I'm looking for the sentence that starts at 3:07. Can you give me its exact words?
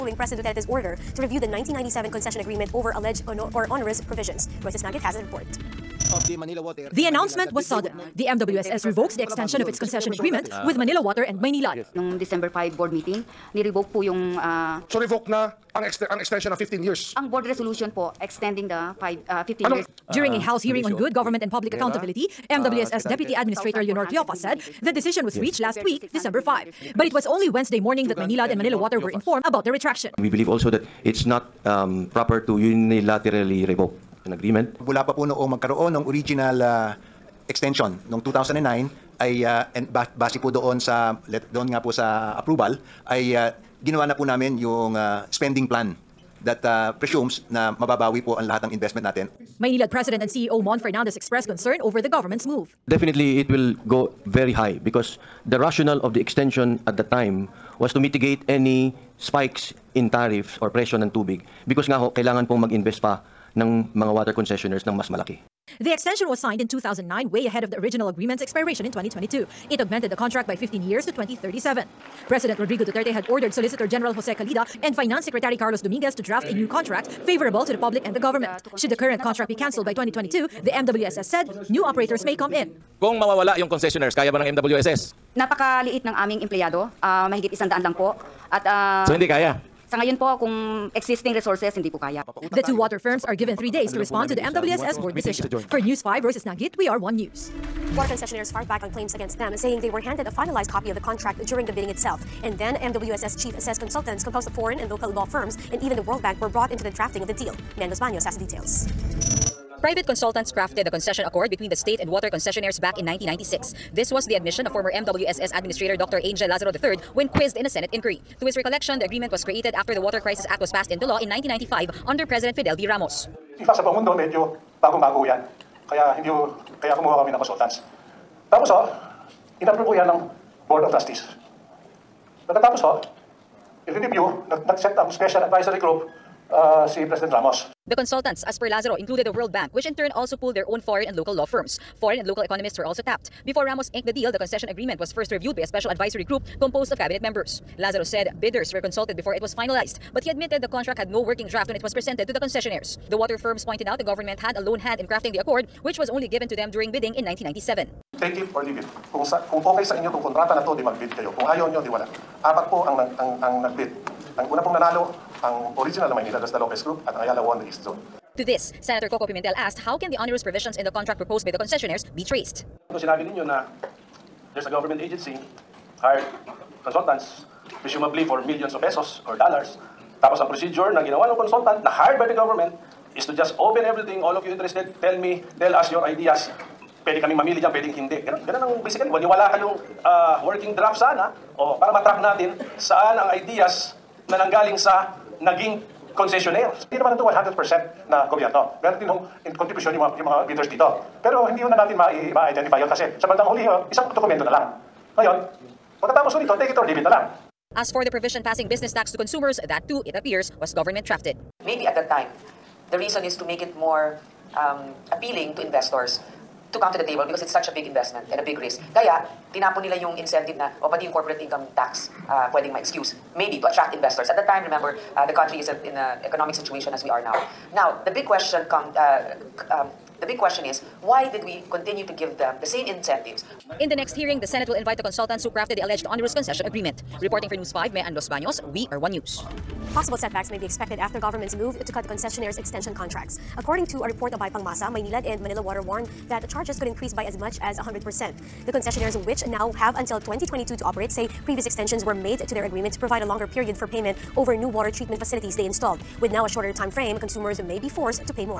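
Pwede kaming mamili dyan, pwedeng hindi.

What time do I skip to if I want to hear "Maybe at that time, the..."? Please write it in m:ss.
3:31.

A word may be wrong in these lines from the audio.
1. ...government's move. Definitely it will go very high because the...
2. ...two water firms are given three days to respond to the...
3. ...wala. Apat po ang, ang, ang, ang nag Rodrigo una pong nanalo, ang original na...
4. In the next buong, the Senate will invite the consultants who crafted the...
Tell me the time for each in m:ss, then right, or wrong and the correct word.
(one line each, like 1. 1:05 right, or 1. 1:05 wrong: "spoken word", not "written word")
1. 0:52 right
2. 1:32 right
3. 2:41 wrong: "Ang", not "Rodrigo"
4. 3:53 wrong: "hearing", not "buong".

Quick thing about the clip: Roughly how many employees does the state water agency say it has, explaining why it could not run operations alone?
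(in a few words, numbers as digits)
over 100.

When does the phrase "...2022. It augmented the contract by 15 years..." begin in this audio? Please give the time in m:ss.
1:08.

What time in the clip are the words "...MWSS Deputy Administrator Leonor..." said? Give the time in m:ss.
0:22.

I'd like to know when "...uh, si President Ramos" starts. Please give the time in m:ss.
2:16.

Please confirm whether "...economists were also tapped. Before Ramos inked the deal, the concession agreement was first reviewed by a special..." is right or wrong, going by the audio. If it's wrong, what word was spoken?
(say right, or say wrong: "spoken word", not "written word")
right.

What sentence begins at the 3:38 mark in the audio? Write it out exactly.
Kaya, tinapon nila yung incentive na, o pati yung corporate income tax, uh, pwedeng ma-excuse maybe to attract investors.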